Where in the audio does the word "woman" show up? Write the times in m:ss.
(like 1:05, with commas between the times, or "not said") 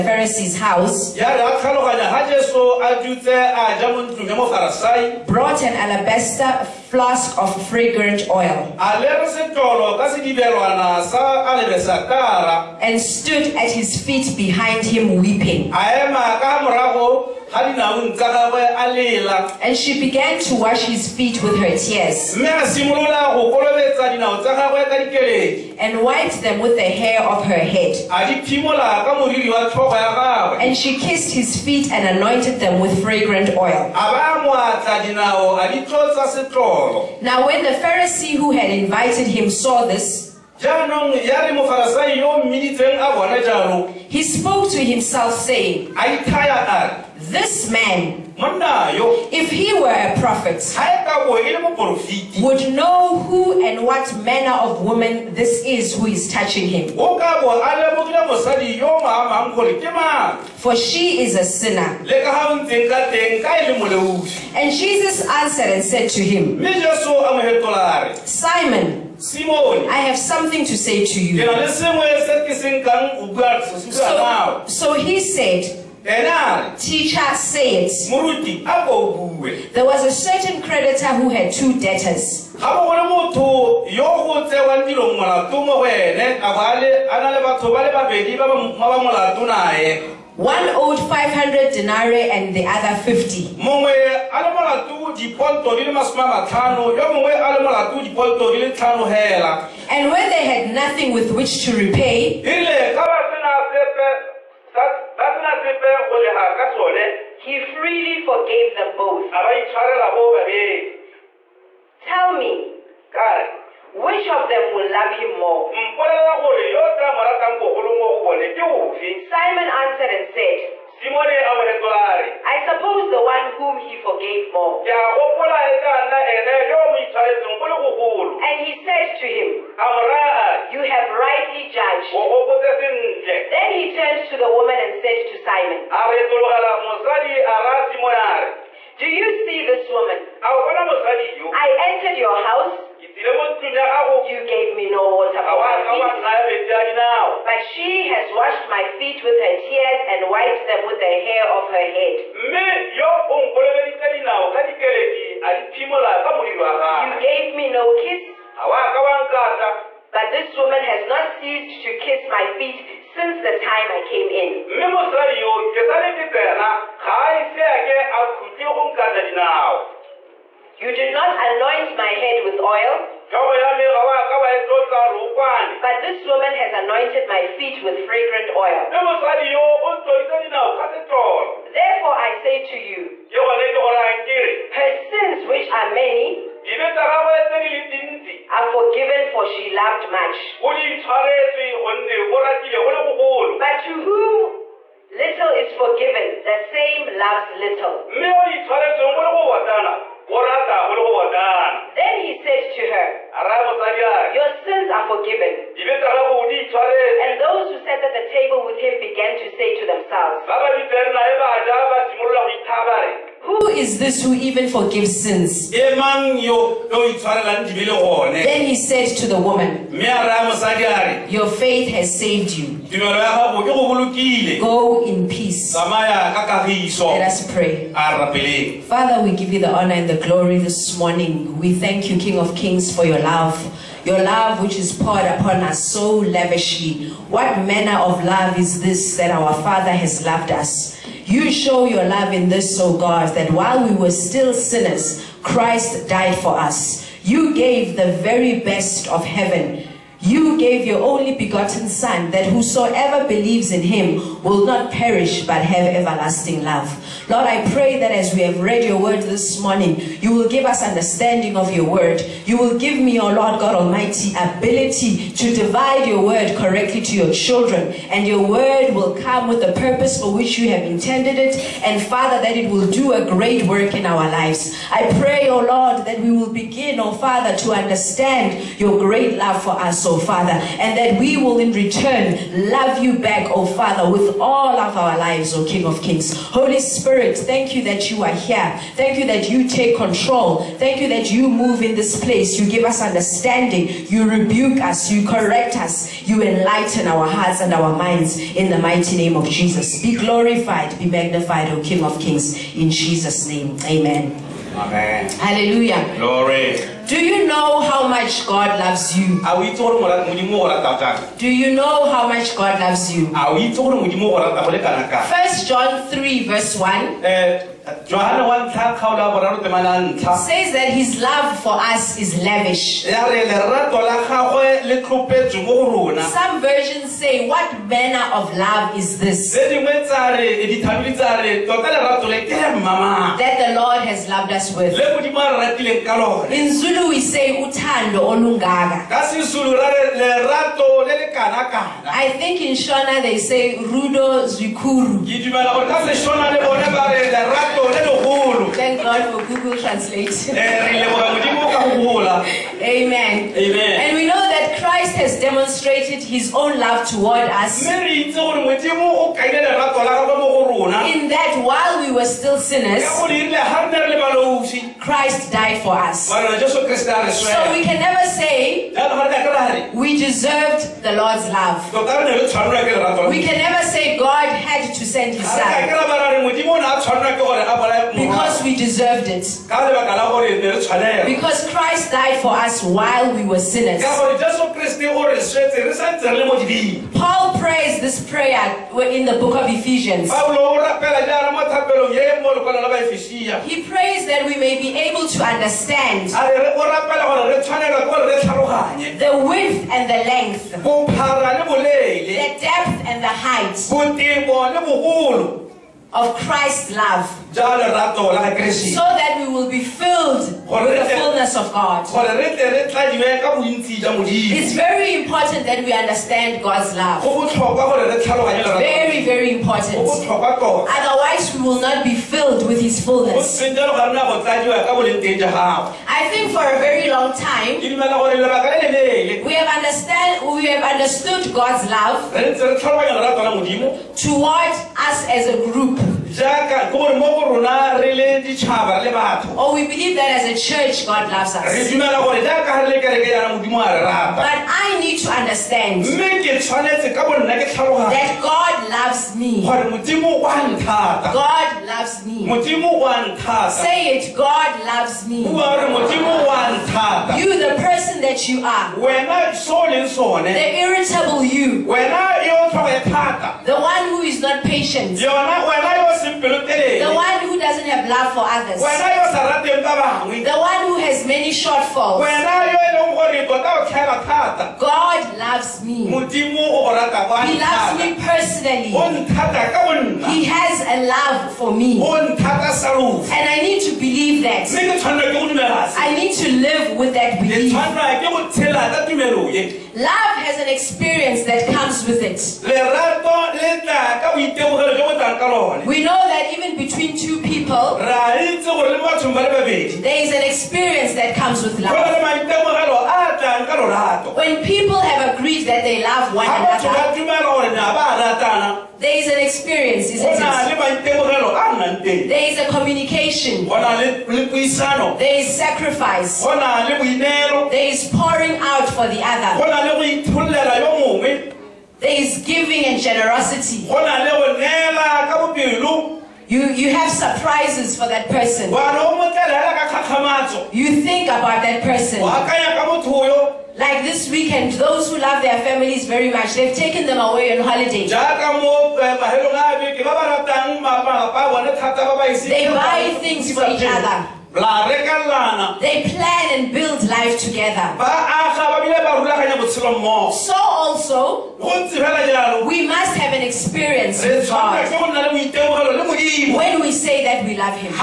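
0:54, 2:14, 2:19, 2:40, 2:56, 3:39.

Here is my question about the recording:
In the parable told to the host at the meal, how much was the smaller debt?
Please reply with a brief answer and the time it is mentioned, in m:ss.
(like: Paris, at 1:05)
50, at 1:33.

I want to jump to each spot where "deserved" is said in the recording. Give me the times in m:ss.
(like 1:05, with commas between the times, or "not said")
6:10, 6:18.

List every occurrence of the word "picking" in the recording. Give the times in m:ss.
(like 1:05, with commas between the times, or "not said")
not said.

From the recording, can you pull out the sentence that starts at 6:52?
It's very important that we understand God's love.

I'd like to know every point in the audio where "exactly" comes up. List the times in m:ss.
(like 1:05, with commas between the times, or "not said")
not said.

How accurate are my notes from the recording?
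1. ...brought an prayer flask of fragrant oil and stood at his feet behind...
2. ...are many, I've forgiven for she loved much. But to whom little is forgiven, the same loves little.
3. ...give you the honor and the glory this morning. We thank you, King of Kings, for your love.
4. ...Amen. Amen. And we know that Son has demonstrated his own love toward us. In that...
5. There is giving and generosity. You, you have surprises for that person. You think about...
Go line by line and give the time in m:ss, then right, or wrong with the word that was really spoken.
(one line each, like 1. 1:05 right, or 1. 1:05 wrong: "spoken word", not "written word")
1. 0:05 wrong: "alabaster", not "prayer"
2. 3:05 right
3. 3:49 right
4. 5:53 wrong: "Christ", not "Son"
5. 8:42 right.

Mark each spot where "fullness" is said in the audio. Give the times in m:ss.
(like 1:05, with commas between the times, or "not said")
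6:51, 7:03.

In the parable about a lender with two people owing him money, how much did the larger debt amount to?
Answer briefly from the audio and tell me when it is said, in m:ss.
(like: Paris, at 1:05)
500 denarii, at 1:31.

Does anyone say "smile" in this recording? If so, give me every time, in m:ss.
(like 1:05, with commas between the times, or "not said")
not said.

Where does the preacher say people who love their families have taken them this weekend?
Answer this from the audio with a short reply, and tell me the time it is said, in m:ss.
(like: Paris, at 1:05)
On holiday, at 8:57.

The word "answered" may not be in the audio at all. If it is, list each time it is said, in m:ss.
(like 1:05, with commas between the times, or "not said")
1:05, 1:59.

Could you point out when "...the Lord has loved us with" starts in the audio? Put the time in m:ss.
5:33.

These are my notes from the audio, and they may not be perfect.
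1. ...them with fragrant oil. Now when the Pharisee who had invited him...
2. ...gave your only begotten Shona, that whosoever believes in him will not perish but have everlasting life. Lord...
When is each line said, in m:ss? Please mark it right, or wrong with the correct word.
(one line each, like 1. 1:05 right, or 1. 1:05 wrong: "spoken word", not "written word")
1. 0:32 right
2. 4:10 wrong: "Son", not "Shona".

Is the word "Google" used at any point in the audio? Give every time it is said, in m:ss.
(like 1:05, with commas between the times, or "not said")
5:49.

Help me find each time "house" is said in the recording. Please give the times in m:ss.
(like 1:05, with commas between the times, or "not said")
0:00, 2:22.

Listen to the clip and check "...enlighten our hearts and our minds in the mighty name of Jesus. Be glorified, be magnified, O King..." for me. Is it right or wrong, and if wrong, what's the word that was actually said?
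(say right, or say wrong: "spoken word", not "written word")
right.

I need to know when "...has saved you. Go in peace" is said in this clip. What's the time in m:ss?
3:41.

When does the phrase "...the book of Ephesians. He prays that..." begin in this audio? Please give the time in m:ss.
6:29.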